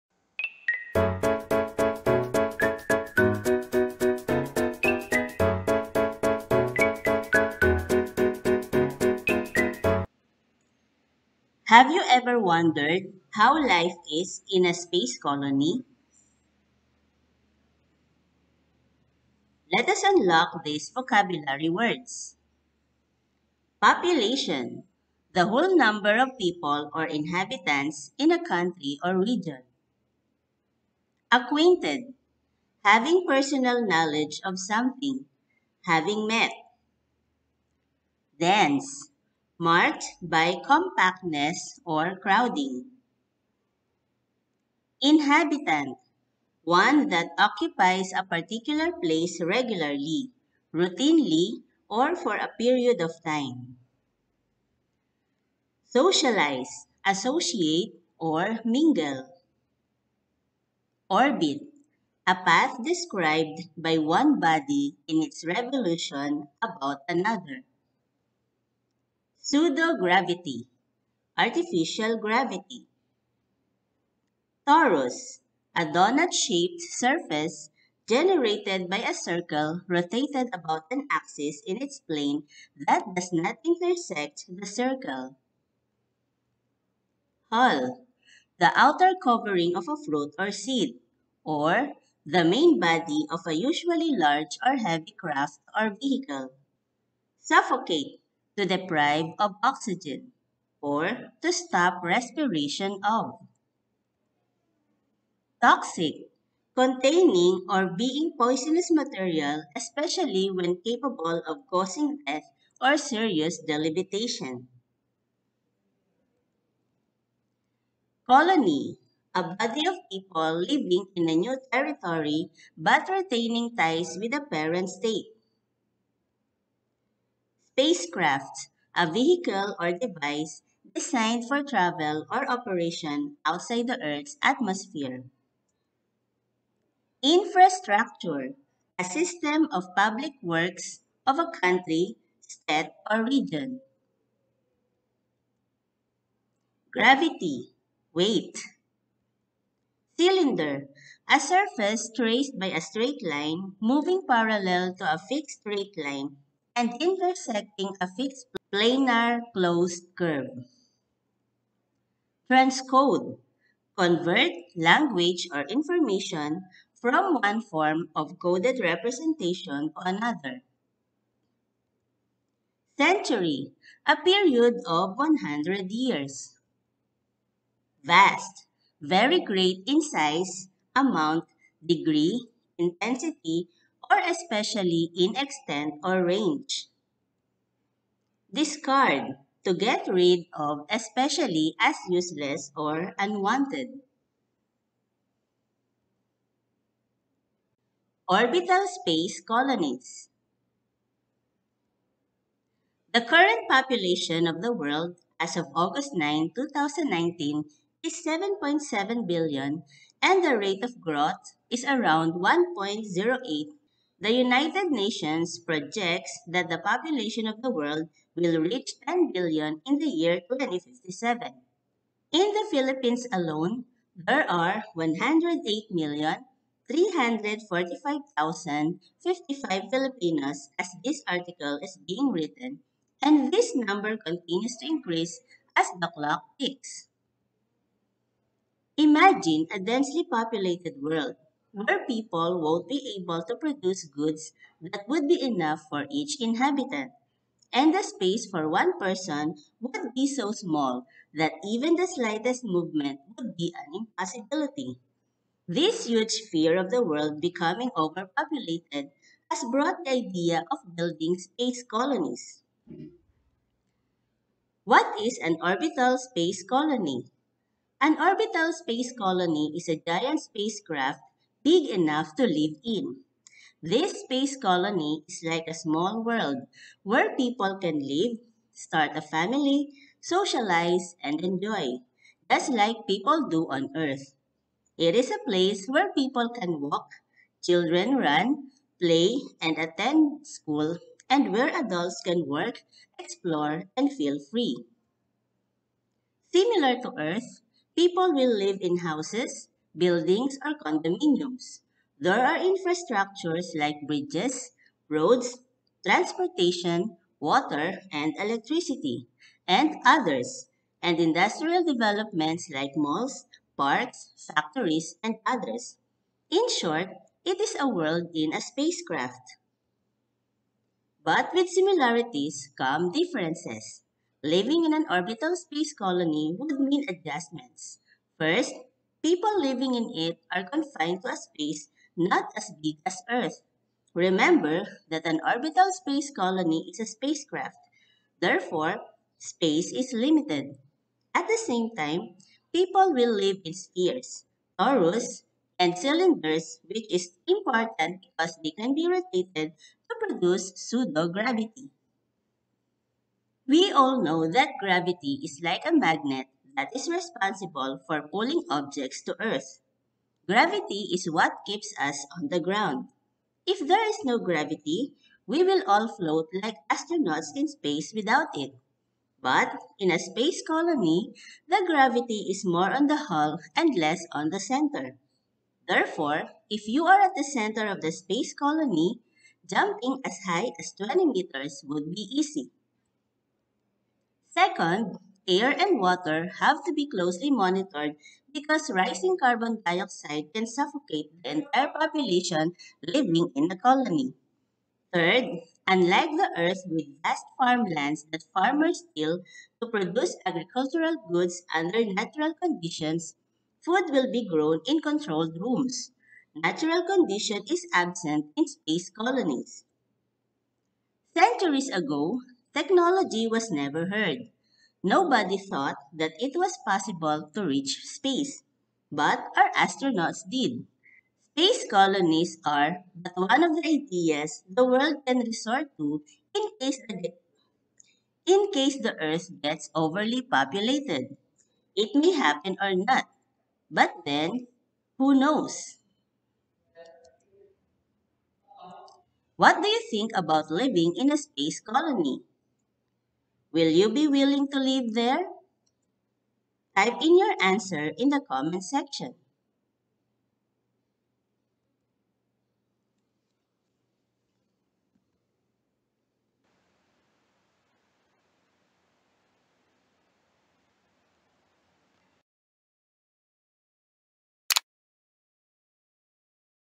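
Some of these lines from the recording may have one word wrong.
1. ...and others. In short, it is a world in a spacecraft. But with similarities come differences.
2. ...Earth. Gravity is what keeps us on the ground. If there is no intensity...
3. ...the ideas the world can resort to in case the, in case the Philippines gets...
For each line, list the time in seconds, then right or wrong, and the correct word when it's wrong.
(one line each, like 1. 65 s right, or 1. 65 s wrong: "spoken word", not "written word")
1. 315 s right
2. 359 s wrong: "gravity", not "intensity"
3. 423 s wrong: "Earth", not "Philippines".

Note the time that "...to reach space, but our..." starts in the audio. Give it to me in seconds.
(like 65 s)
417 s.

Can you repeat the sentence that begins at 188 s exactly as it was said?
Discard to get rid of especially as useless or unwanted.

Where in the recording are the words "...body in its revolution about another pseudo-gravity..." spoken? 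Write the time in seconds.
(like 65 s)
64 s.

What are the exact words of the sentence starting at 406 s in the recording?
Natural condition is absent in space colonies.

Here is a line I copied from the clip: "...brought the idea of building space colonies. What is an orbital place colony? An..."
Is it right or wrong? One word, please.
wrong.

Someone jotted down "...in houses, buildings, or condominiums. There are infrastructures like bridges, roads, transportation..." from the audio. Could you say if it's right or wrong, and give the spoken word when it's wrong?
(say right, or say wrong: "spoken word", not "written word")
right.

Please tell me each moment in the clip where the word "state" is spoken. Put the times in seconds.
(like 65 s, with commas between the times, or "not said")
124 s, 142 s.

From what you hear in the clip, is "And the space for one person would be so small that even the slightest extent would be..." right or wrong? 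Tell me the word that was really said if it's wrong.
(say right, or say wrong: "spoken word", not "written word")
wrong: "movement", not "extent".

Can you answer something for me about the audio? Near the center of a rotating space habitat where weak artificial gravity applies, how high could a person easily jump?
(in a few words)
20 meters.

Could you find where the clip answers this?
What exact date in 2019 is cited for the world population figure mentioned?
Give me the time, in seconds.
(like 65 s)
205 s.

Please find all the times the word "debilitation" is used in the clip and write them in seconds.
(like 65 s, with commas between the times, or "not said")
113 s.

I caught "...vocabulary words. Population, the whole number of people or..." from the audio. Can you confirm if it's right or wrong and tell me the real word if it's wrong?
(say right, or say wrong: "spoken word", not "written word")
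right.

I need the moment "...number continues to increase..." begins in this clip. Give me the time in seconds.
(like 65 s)
233 s.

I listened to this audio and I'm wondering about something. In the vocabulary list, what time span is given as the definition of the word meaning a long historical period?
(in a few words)
100 years.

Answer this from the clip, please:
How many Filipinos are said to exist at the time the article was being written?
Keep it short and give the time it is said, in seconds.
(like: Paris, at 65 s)
108,345,055, at 224 s.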